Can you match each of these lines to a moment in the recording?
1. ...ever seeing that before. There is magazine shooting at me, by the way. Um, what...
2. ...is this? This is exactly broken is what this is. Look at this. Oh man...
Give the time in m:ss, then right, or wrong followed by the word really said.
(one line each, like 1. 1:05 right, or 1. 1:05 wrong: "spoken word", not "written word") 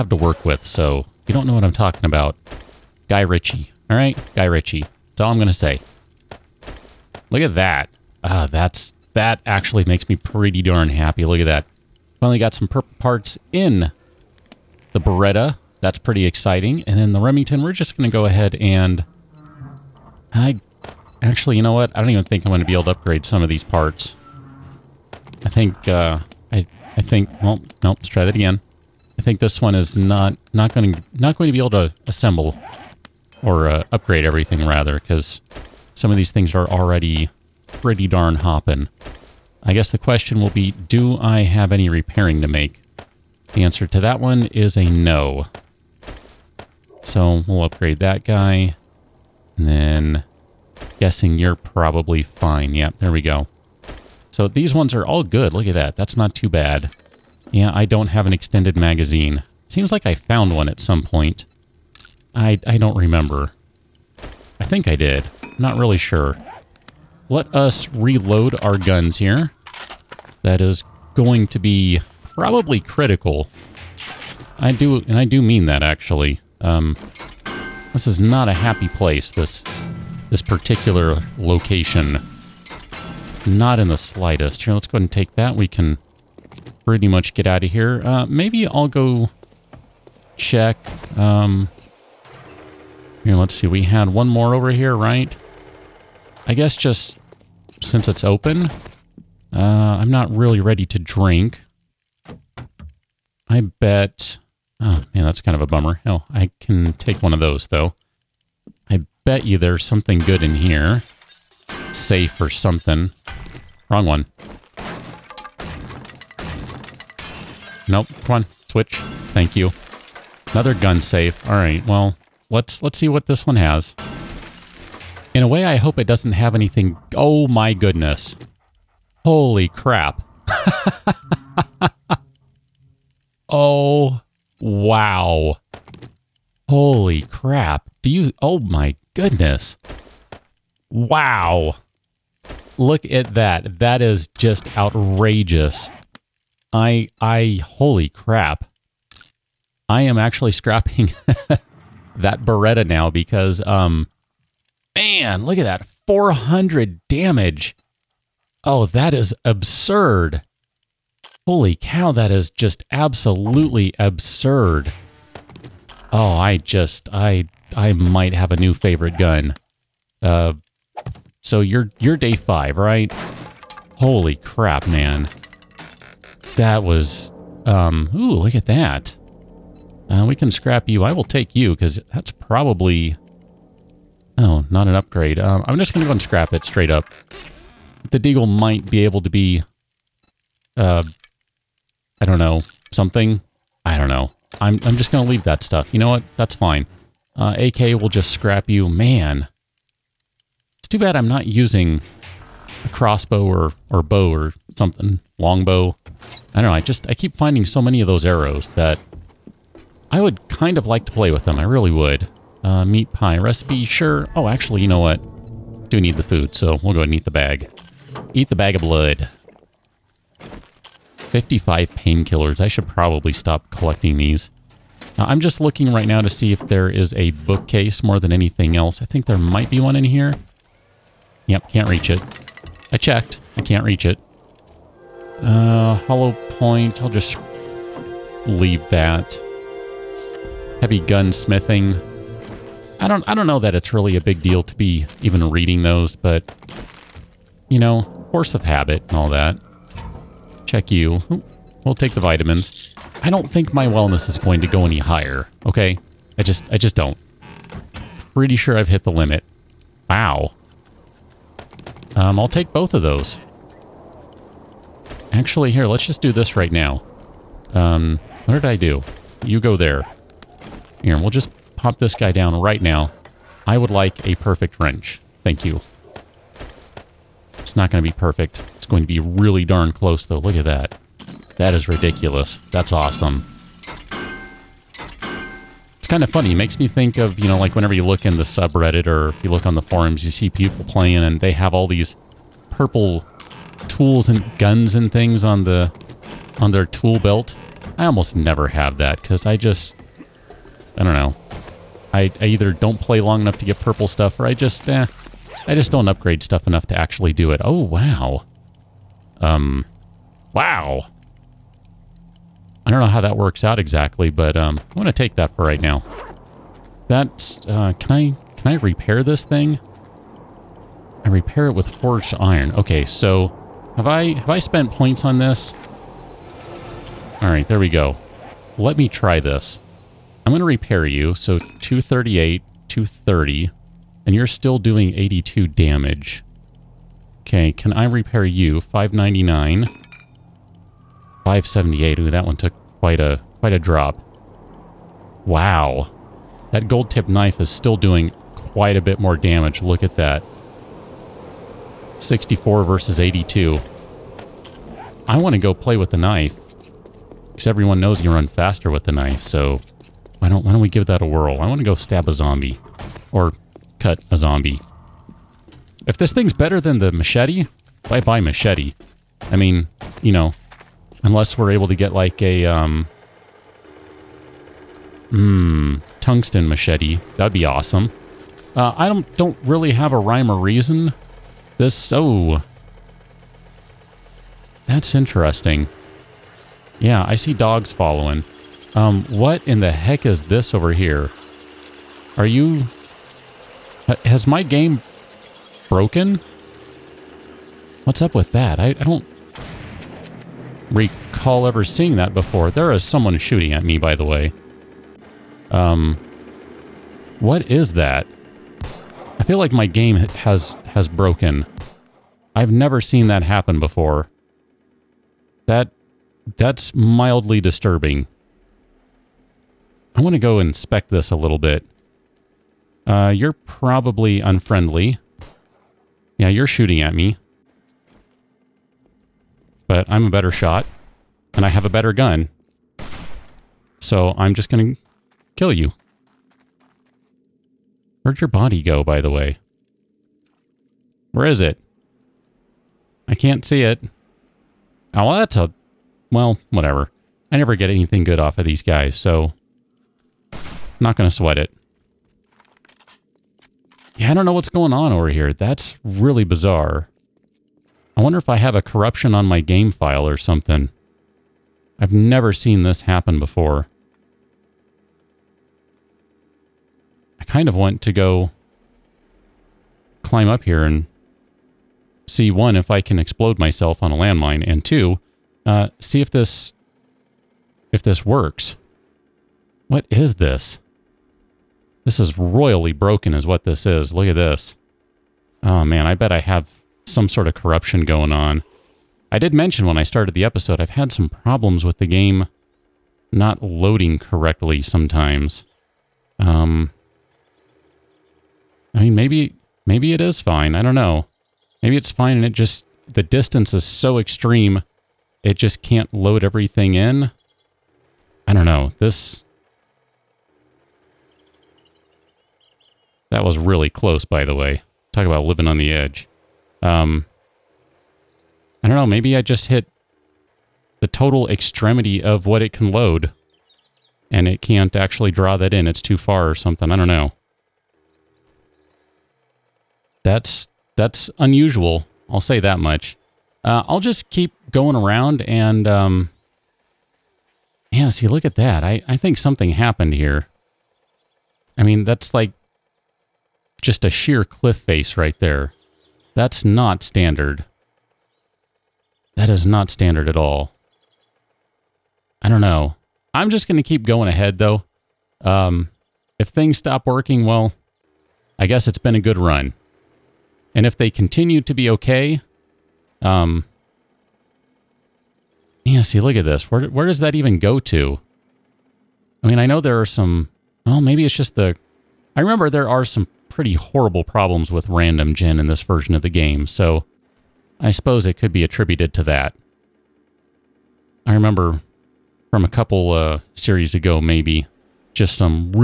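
1. 6:41 wrong: "someone", not "magazine"
2. 8:00 wrong: "royally", not "exactly".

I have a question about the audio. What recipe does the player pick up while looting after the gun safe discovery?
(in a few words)
meat pie.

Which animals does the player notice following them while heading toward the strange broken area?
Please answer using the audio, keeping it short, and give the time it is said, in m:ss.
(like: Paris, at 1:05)
dogs, at 6:27.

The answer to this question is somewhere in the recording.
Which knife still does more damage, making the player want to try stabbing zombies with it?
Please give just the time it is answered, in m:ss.
5:46.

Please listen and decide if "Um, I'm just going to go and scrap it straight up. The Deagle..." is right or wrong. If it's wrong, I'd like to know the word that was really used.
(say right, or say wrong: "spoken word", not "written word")
right.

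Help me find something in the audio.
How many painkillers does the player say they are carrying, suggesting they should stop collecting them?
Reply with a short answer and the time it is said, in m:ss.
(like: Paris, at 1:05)
55, at 3:41.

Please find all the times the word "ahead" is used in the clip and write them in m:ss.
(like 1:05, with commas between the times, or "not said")
0:18, 1:24, 3:36, 9:14.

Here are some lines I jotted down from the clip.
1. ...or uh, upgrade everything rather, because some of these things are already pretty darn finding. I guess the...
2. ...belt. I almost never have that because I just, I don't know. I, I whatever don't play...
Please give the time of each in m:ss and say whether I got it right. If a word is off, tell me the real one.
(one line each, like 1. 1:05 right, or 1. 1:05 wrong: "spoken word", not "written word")
1. 0:33 wrong: "hopping", not "finding"
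2. 4:57 wrong: "either", not "whatever".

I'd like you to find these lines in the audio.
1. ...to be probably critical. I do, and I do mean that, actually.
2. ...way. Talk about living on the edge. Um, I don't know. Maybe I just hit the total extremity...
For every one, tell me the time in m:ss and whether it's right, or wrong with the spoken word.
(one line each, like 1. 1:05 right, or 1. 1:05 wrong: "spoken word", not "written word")
1. 1:11 right
2. 8:34 right.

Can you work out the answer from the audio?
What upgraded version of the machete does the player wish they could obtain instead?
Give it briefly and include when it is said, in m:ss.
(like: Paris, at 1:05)
tungsten machete, at 6:16.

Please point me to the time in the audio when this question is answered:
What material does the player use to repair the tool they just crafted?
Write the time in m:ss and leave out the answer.
5:21.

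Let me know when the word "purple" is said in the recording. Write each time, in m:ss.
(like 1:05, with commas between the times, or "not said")
0:12, 4:52, 5:03.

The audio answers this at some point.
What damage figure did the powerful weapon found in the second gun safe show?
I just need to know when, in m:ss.
2:36.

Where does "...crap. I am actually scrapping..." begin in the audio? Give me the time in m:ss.
2:28.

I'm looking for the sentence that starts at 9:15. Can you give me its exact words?
Um, if things stop working, well, I guess it's been a good run.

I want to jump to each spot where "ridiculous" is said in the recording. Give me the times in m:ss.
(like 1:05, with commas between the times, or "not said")
4:41.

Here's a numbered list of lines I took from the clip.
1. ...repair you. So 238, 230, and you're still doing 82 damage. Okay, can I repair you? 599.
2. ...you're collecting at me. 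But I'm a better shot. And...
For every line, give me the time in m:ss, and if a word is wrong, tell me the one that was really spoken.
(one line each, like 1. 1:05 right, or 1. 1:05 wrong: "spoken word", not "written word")
1. 5:30 right
2. 7:06 wrong: "shooting", not "collecting".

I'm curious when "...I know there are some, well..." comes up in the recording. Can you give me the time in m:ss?
9:29.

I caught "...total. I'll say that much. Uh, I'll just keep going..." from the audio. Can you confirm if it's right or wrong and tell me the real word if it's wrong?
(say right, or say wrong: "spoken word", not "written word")
wrong: "unusual", not "total".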